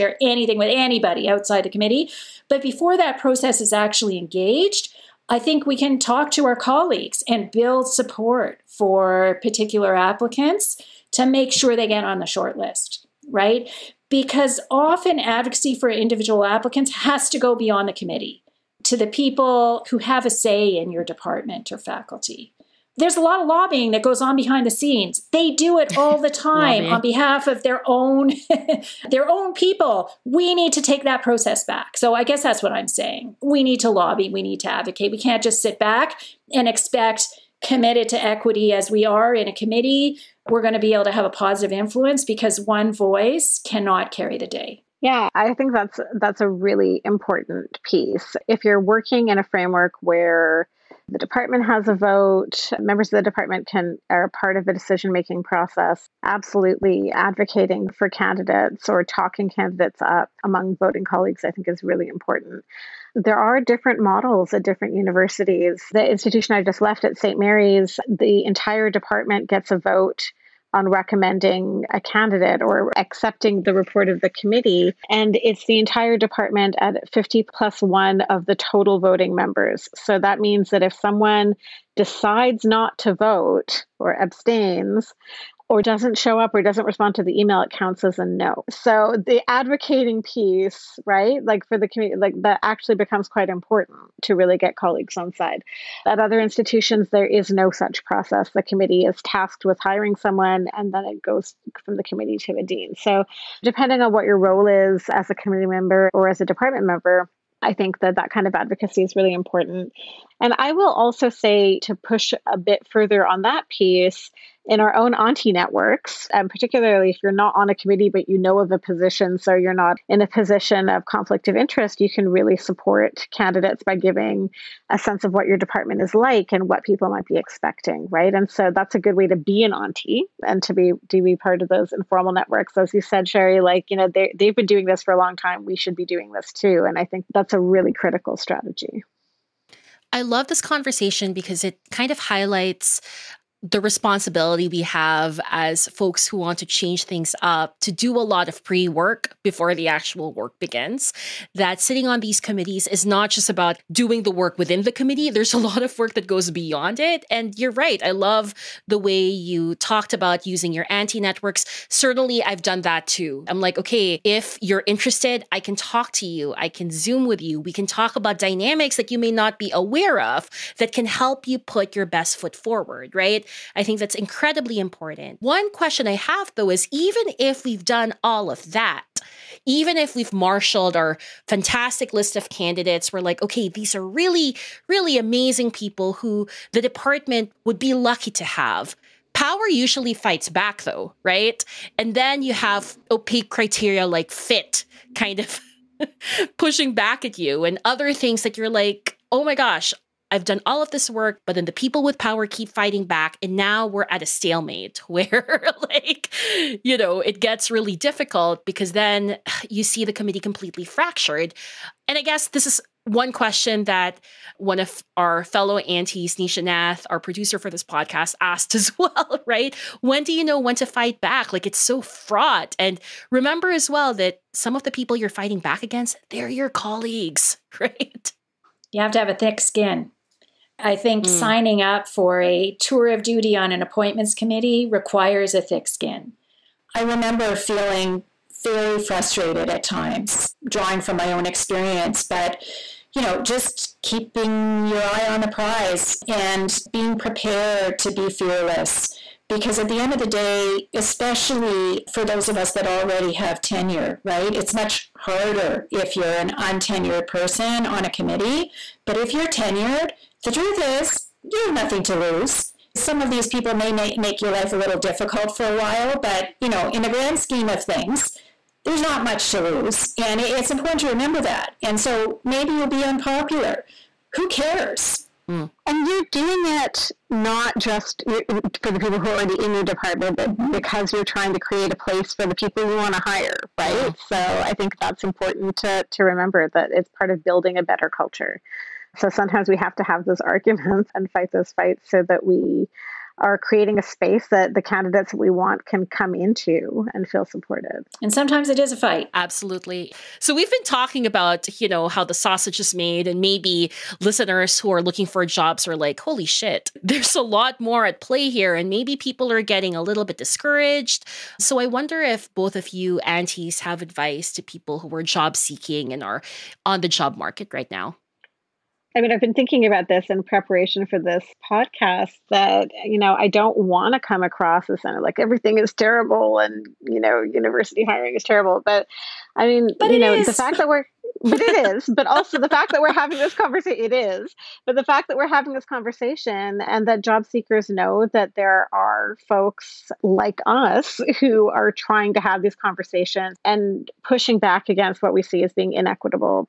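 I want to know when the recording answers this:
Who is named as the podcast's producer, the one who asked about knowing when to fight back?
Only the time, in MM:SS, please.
03:36.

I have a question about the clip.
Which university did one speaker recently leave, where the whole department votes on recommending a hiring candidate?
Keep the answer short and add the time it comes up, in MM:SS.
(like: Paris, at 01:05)
St. Mary's, at 01:07.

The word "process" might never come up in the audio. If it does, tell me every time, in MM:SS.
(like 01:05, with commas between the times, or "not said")
00:03, 00:31, 00:55, 01:38.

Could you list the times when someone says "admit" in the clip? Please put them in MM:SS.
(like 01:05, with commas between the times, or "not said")
not said.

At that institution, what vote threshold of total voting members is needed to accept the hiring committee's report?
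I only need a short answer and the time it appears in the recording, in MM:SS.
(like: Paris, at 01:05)
50 plus one, at 01:17.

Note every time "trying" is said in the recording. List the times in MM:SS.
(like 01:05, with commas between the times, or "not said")
04:41, 05:41.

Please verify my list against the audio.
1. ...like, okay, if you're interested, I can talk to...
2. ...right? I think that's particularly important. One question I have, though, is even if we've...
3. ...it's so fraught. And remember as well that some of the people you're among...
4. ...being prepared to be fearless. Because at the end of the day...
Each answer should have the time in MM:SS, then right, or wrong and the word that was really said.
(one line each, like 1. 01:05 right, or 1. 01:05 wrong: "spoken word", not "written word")
1. 02:43 right
2. 02:53 wrong: "incredibly", not "particularly"
3. 03:41 wrong: "fighting", not "among"
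4. 04:06 right.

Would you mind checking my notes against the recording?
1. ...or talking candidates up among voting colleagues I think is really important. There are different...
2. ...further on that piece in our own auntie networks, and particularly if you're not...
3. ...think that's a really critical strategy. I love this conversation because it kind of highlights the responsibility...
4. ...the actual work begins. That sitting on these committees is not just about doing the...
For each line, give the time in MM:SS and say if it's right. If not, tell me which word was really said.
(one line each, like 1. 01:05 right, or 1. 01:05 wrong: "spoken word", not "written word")
1. 00:58 right
2. 01:52 right
3. 02:17 right
4. 02:29 right.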